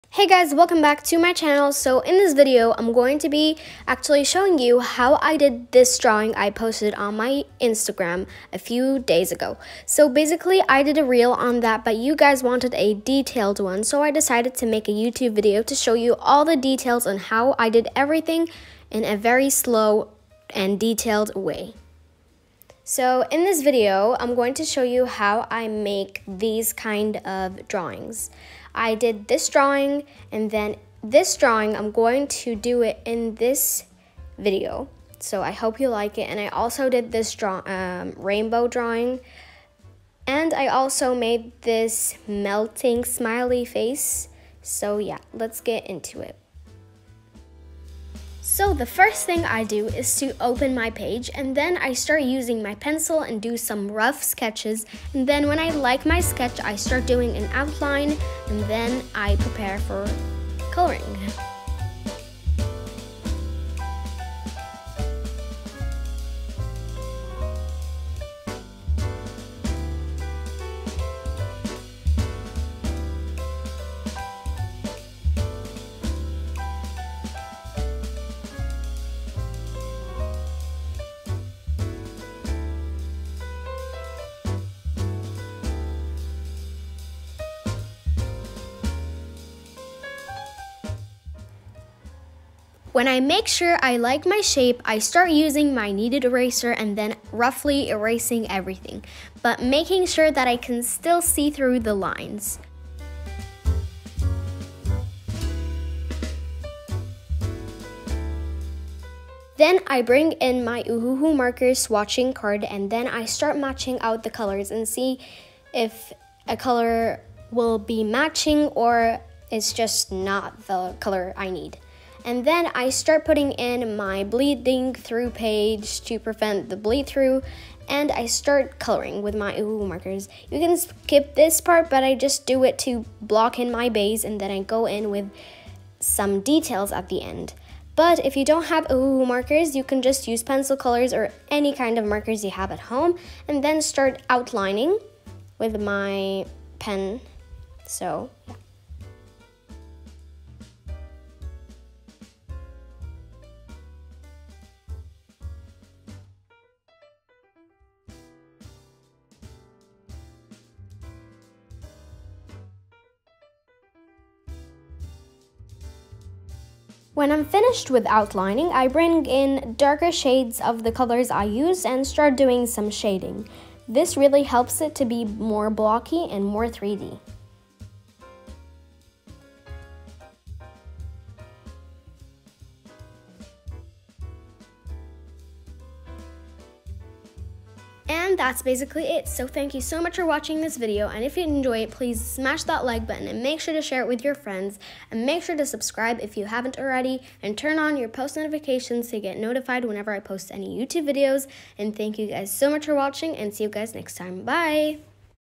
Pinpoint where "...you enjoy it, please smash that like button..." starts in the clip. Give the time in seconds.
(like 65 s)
191 s.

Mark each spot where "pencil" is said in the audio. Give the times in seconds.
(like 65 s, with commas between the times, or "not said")
52 s, 140 s.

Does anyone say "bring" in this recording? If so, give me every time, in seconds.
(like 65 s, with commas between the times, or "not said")
110 s, 168 s.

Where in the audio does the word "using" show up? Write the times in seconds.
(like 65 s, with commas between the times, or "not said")
52 s, 95 s.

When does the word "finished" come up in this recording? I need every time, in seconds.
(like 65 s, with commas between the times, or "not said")
167 s.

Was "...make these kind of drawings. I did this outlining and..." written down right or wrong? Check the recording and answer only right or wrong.
wrong.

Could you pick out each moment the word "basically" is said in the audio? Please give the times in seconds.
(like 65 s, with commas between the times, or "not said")
10 s, 188 s.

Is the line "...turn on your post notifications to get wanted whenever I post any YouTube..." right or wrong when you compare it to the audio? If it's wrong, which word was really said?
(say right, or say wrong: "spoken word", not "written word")
wrong: "notified", not "wanted".